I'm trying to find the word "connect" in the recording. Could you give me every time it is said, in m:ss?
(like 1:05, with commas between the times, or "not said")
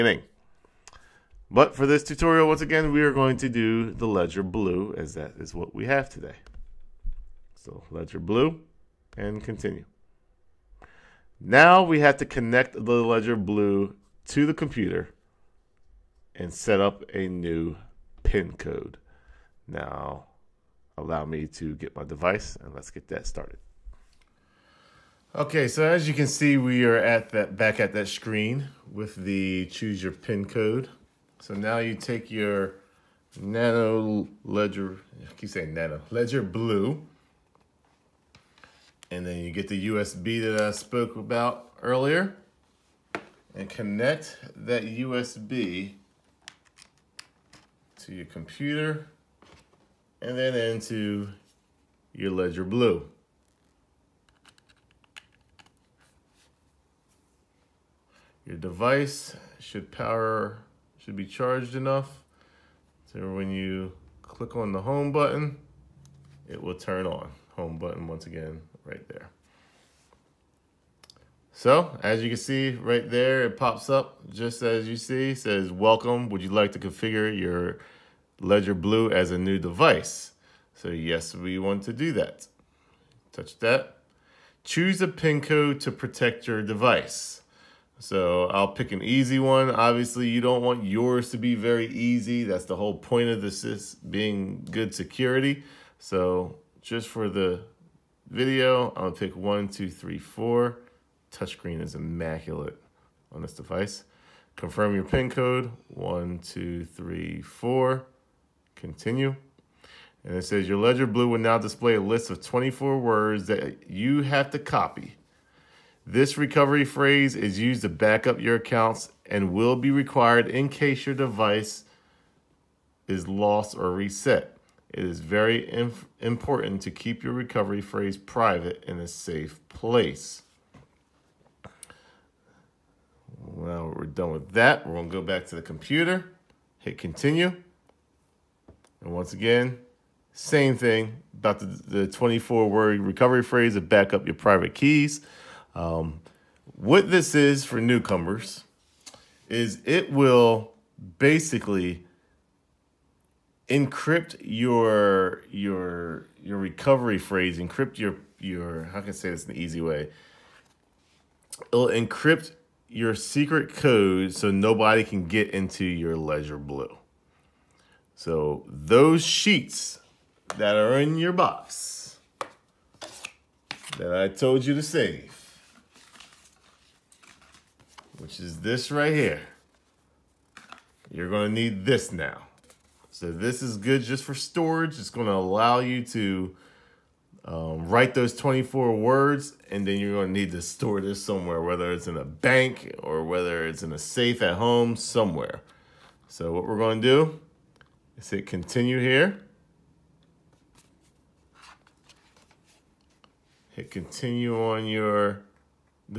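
0:12, 0:43.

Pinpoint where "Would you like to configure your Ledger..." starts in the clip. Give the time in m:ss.
1:16.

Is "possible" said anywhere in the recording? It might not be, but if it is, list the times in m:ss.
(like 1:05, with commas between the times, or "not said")
not said.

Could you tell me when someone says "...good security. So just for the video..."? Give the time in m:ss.
1:34.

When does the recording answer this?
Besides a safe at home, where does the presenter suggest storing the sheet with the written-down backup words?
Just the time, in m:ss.
3:12.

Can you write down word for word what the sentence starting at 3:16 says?
So what we're gonna do is hit continue here.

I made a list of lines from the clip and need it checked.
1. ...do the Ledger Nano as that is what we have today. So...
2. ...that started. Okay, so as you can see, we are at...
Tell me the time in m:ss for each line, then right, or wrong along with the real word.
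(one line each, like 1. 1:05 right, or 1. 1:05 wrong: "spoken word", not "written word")
1. 0:03 wrong: "Blue", not "Nano"
2. 0:23 right.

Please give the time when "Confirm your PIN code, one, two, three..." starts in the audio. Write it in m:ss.
1:44.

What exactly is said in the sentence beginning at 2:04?
It is very important to keep your recovery phrase private in a safe place.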